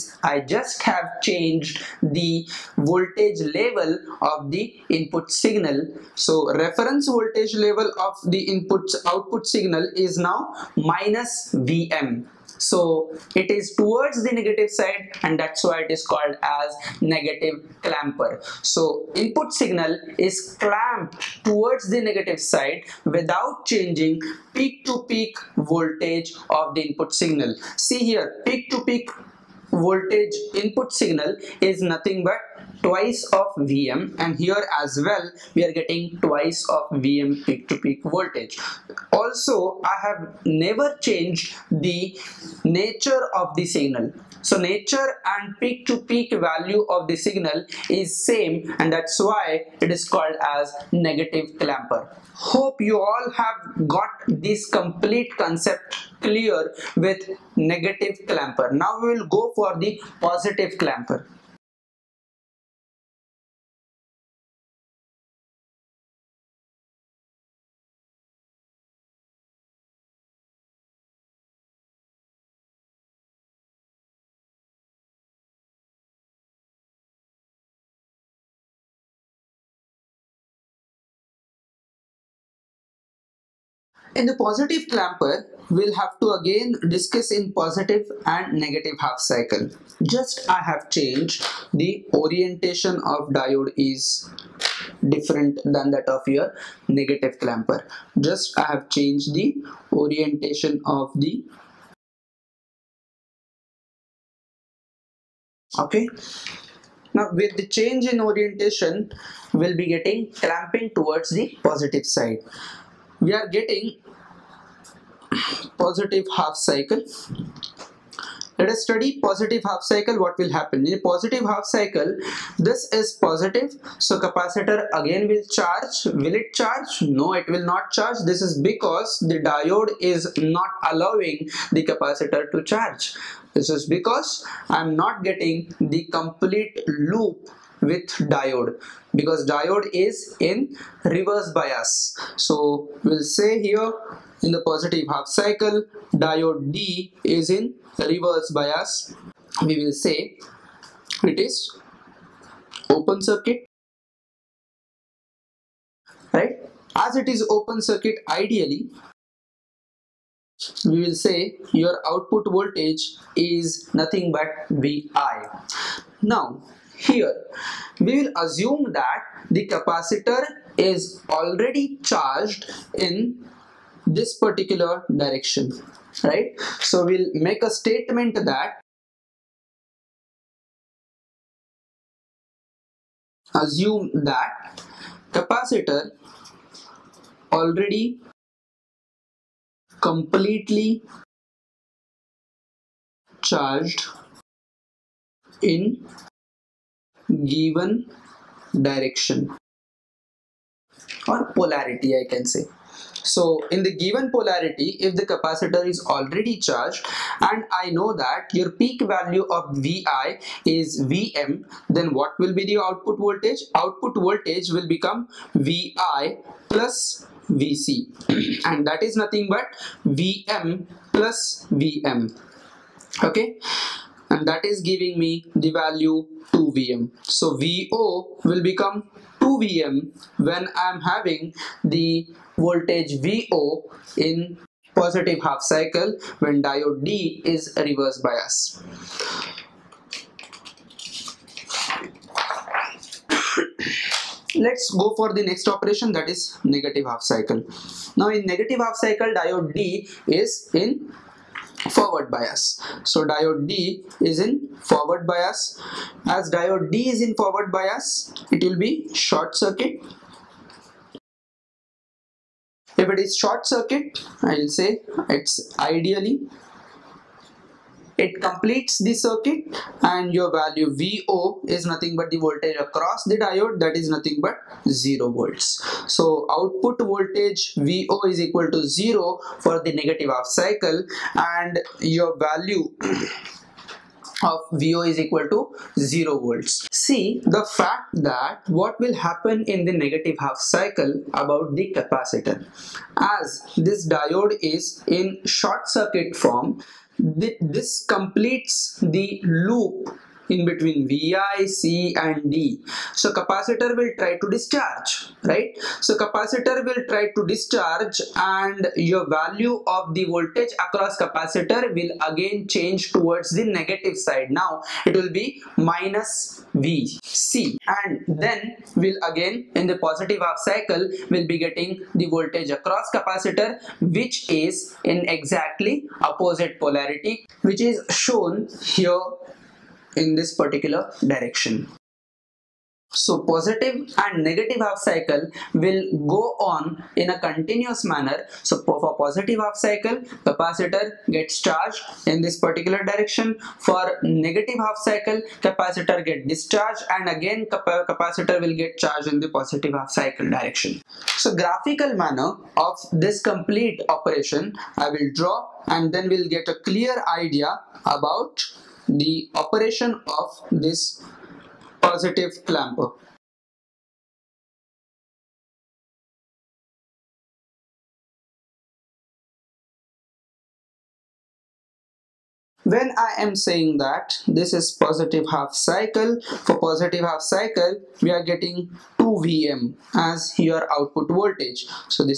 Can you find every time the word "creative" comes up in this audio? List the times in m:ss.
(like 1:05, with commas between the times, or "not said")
not said.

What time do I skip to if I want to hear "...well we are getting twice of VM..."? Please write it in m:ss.
0:35.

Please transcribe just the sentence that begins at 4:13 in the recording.
So diode D is in forward bias.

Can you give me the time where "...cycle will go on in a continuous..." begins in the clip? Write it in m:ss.
5:34.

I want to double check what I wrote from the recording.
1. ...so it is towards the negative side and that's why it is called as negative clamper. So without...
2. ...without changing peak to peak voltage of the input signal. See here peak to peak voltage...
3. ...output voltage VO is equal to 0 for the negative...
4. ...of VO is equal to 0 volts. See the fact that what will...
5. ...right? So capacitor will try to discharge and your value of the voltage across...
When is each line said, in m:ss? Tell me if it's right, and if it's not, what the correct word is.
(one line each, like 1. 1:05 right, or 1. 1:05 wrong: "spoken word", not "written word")
1. 0:12 wrong: "input", not "without"
2. 0:23 right
3. 4:36 right
4. 4:44 right
5. 5:05 right.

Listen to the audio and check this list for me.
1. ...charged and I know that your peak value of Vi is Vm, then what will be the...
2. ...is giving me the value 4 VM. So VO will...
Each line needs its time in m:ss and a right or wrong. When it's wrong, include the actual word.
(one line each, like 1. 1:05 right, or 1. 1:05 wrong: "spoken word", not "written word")
1. 3:26 right
2. 3:44 wrong: "2", not "4".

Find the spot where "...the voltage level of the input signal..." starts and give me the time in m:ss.
0:02.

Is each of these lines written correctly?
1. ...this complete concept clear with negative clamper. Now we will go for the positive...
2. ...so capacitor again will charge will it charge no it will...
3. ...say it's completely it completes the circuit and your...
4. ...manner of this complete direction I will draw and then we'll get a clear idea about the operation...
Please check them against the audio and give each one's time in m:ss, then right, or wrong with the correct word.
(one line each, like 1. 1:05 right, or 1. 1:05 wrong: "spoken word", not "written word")
1. 0:54 right
2. 2:04 right
3. 4:24 wrong: "ideally", not "completely"
4. 5:52 wrong: "operation", not "direction".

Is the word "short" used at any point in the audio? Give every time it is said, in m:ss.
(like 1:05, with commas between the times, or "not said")
4:19, 4:23, 4:55.